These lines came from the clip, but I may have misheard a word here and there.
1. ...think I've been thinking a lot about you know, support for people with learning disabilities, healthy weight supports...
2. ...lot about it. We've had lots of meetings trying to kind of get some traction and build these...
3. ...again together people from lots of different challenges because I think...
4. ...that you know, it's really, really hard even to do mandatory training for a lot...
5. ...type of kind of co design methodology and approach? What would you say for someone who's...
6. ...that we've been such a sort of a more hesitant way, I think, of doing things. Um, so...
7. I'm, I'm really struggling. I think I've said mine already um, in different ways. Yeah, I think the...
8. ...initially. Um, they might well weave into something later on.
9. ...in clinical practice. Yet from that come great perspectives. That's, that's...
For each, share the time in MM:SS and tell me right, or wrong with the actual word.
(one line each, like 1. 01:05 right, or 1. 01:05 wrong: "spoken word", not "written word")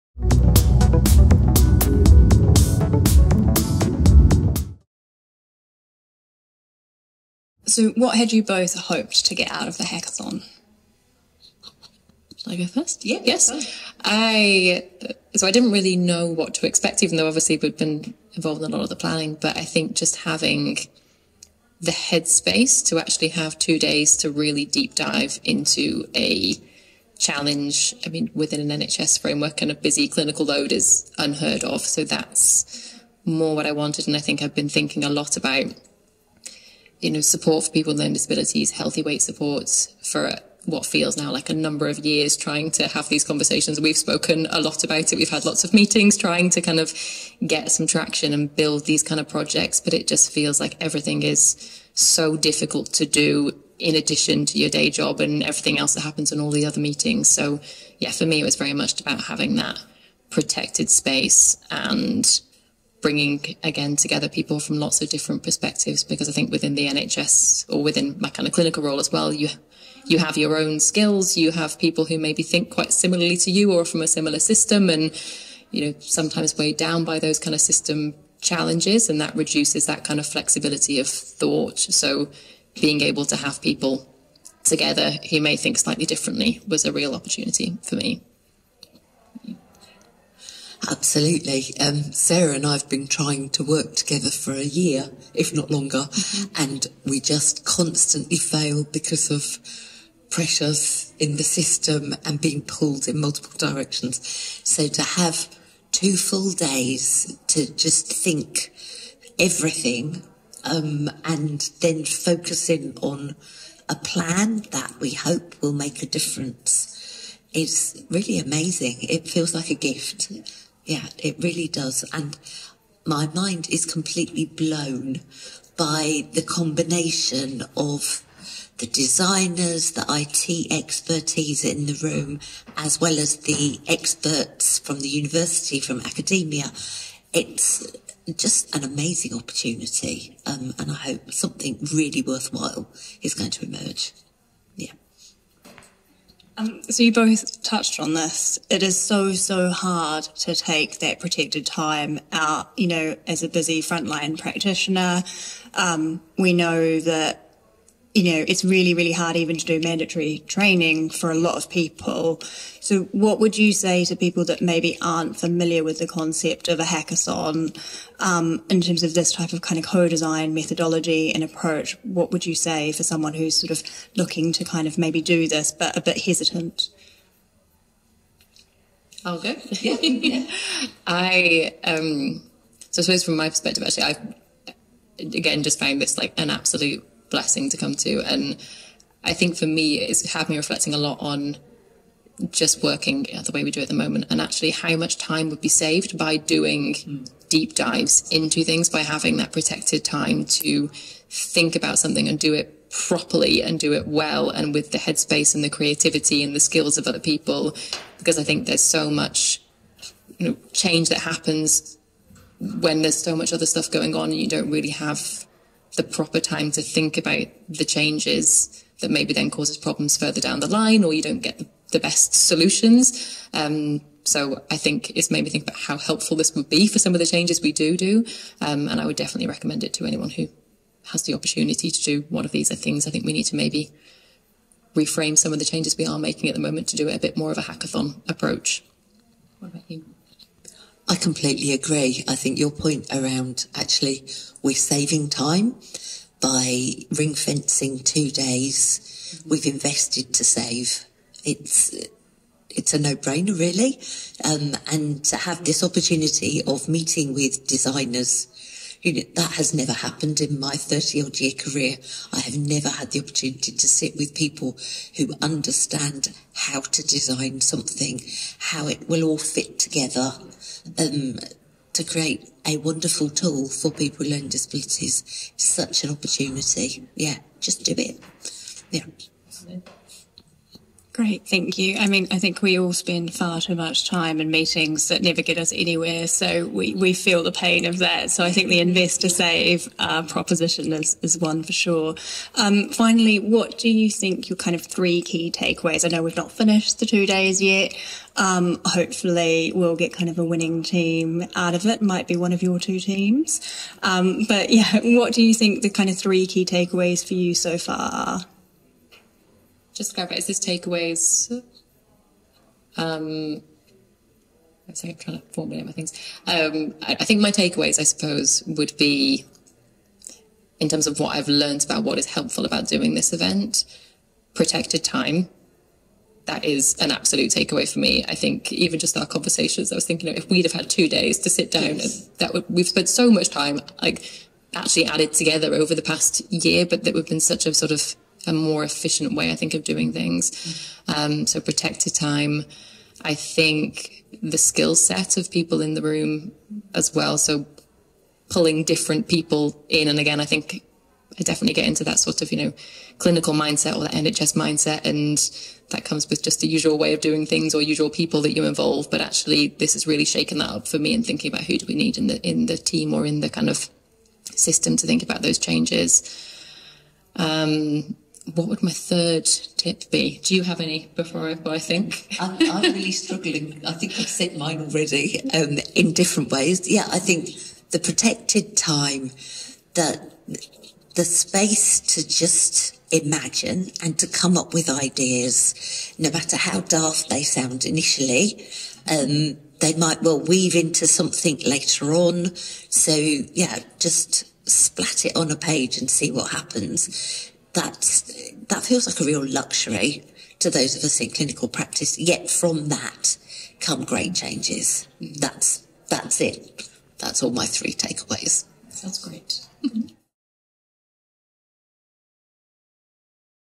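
1. 00:34 right
2. 00:44 right
3. 01:03 wrong: "perspectives", not "challenges"
4. 02:36 right
5. 02:49 right
6. 05:37 wrong: "efficient", not "hesitant"
7. 06:12 right
8. 06:27 right
9. 06:41 wrong: "changes", not "perspectives".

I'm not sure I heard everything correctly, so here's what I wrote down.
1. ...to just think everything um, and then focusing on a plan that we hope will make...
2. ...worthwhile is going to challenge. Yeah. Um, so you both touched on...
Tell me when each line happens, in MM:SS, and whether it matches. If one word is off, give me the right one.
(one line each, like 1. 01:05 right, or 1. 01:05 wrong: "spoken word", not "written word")
1. 01:47 right
2. 02:22 wrong: "emerge", not "challenge".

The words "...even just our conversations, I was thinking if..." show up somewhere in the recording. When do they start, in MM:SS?
05:28.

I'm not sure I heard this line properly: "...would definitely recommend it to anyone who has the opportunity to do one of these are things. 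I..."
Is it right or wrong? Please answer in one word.
right.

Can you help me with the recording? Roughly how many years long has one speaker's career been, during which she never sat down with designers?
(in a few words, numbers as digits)
30.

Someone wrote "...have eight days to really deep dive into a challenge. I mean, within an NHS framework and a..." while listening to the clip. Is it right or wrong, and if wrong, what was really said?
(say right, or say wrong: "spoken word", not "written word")
wrong: "two", not "eight".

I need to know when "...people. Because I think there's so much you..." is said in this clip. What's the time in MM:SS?
03:27.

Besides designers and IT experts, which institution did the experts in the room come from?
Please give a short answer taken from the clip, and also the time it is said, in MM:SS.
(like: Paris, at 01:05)
university, at 02:15.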